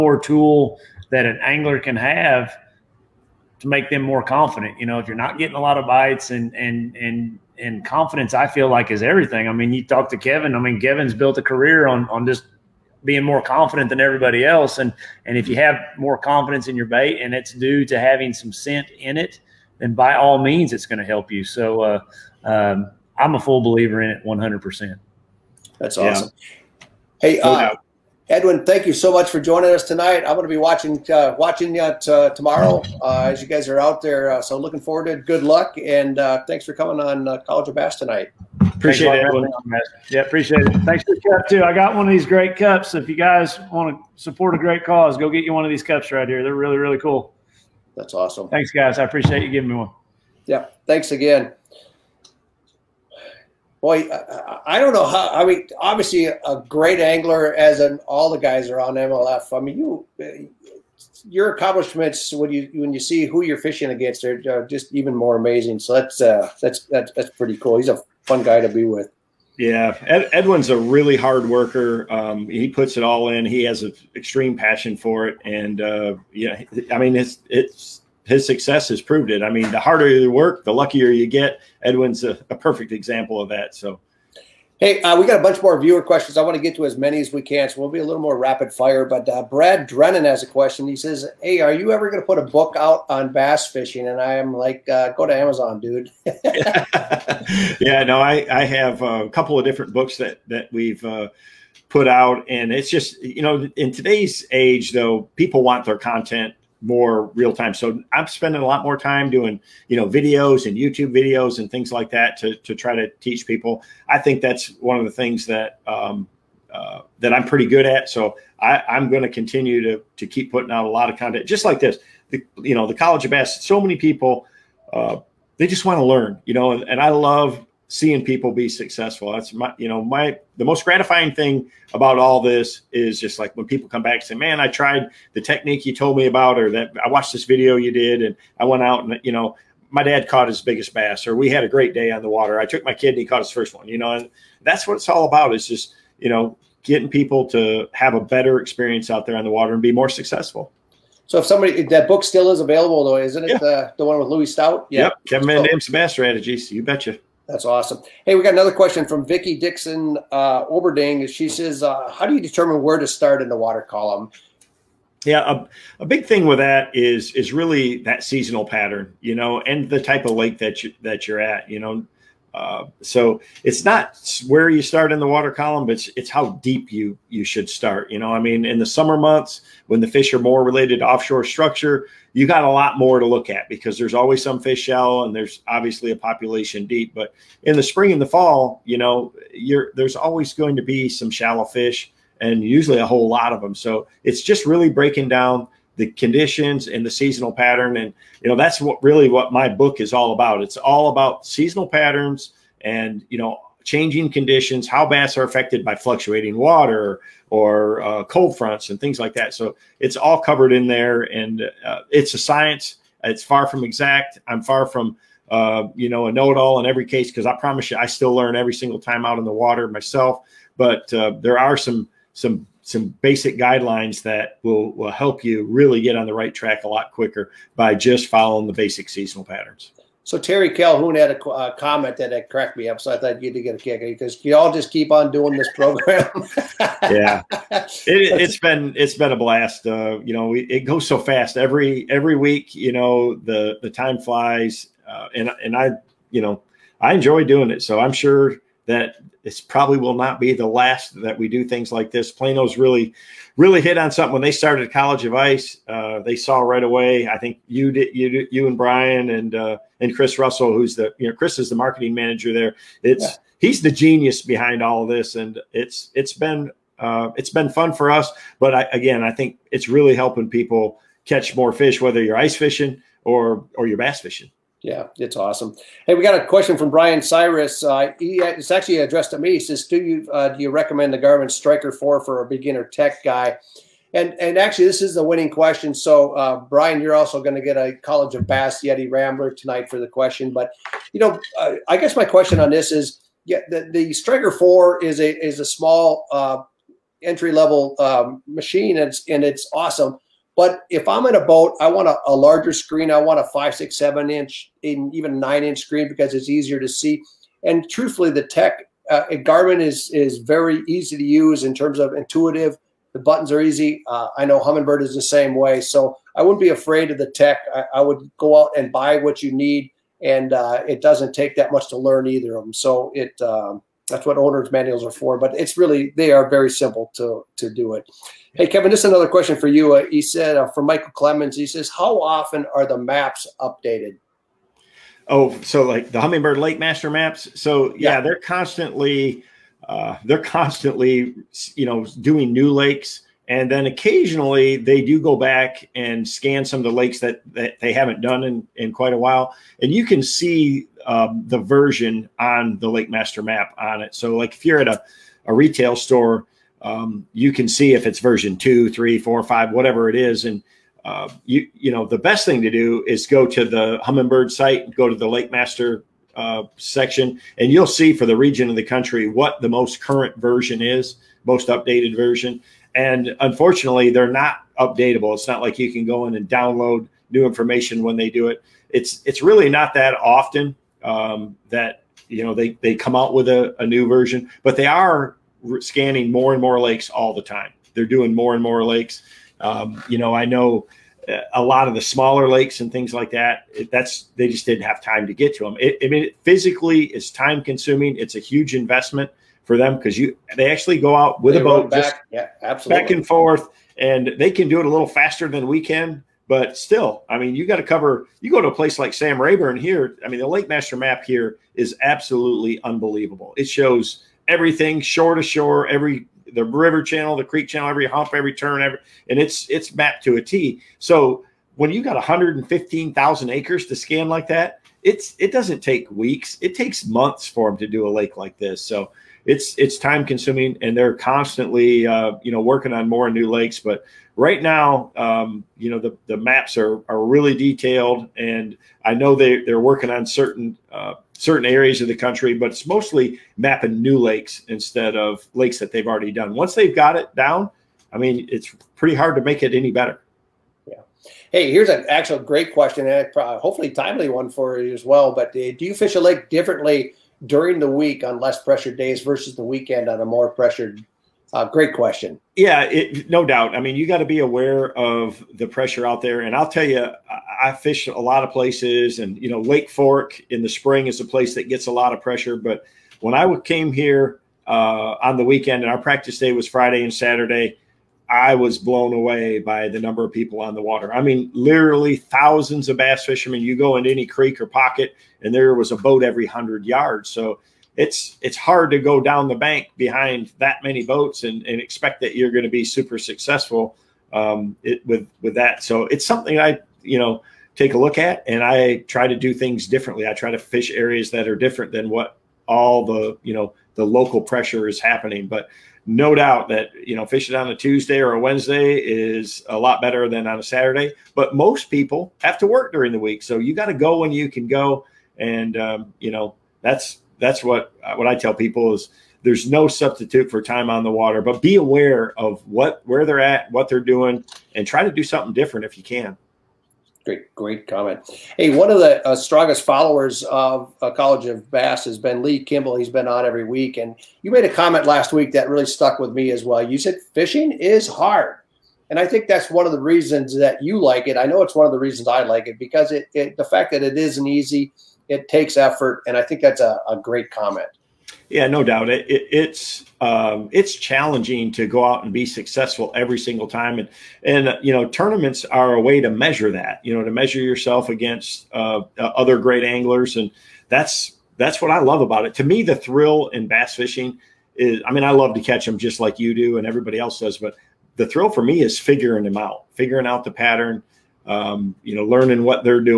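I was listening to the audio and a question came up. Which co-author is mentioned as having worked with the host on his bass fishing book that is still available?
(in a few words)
Louie Stout.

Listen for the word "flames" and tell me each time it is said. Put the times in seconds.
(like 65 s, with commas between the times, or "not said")
not said.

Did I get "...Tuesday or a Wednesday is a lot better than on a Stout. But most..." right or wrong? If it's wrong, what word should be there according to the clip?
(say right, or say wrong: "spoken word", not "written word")
wrong: "Saturday", not "Stout".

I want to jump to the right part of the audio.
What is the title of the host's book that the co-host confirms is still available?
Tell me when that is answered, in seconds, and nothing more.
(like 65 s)
155 s.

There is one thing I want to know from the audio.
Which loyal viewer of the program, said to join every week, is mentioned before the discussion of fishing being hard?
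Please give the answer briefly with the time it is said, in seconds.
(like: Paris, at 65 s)
Lee Kimball, at 532 s.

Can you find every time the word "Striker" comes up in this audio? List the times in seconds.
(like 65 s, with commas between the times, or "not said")
281 s, 294 s.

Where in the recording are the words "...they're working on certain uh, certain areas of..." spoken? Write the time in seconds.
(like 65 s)
439 s.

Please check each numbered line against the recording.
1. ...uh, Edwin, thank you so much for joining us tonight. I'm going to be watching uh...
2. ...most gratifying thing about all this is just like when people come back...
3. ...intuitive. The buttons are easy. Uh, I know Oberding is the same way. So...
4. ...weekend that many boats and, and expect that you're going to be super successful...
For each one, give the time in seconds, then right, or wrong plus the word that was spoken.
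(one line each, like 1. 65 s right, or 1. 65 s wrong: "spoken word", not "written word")
1. 27 s right
2. 130 s right
3. 312 s wrong: "Humminbird", not "Oberding"
4. 489 s wrong: "behind", not "weekend".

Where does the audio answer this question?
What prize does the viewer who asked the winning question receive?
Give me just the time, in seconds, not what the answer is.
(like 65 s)
288 s.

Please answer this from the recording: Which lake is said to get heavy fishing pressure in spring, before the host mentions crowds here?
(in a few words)
Lake Fork.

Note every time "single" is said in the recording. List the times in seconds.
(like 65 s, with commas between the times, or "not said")
218 s, 553 s.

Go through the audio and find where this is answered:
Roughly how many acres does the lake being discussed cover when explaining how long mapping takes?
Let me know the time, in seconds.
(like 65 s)
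422 s.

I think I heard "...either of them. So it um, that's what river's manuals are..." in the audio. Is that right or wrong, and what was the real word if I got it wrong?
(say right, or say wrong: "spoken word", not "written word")
wrong: "owner", not "river".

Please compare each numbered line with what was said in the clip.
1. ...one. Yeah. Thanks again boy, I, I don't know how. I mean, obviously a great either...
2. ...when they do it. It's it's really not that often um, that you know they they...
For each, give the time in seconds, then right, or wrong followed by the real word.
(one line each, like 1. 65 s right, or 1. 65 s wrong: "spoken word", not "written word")
1. 49 s wrong: "angler", not "either"
2. 378 s right.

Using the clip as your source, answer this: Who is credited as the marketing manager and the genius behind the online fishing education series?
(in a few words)
Chris Russell.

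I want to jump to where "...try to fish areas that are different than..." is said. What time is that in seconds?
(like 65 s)
500 s.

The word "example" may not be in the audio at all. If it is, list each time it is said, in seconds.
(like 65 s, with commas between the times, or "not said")
82 s.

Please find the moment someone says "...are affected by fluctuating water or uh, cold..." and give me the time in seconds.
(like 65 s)
205 s.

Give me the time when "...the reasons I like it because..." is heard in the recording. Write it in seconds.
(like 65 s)
541 s.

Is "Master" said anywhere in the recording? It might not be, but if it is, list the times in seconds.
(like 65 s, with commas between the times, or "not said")
336 s, 353 s, 365 s, 410 s.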